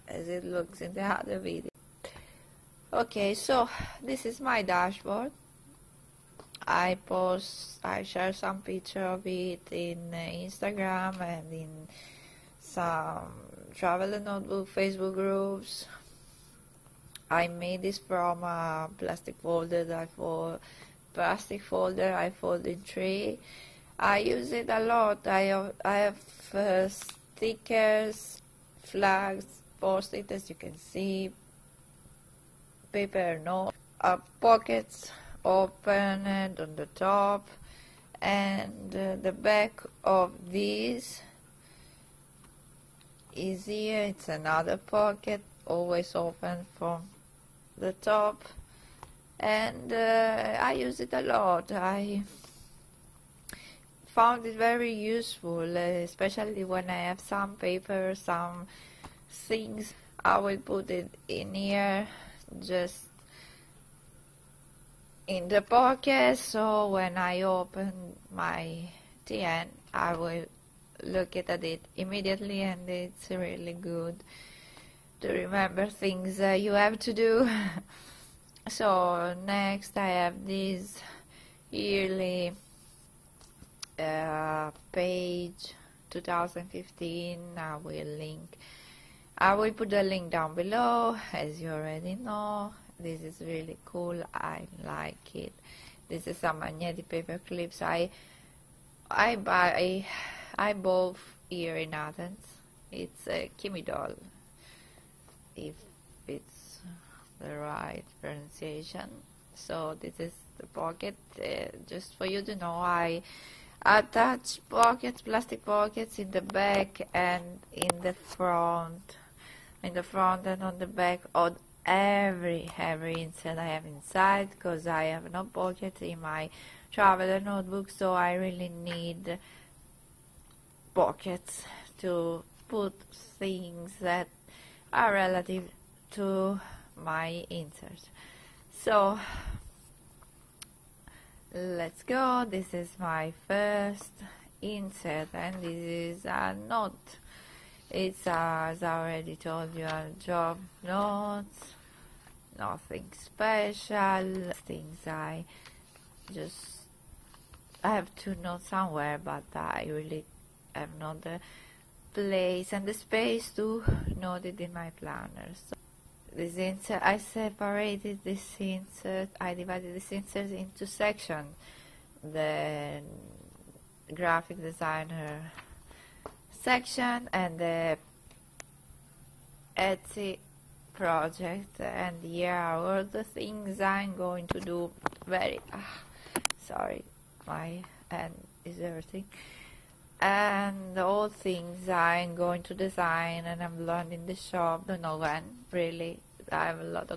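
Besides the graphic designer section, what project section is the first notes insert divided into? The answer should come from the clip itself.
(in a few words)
Etsy project.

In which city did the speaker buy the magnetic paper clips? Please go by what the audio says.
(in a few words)
Athens.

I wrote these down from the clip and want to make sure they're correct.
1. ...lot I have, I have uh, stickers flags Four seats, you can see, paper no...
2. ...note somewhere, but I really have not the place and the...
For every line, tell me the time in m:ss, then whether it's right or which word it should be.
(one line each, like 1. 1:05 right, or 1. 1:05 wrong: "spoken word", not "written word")
1. 0:24 right
2. 2:38 right.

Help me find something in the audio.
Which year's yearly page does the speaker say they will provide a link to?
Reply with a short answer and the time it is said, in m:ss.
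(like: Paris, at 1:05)
2015, at 1:26.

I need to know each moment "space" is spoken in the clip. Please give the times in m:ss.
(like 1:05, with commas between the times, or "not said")
2:42.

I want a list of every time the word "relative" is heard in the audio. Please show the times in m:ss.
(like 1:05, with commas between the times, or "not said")
2:15.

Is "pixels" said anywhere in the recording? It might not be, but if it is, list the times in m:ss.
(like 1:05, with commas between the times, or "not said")
not said.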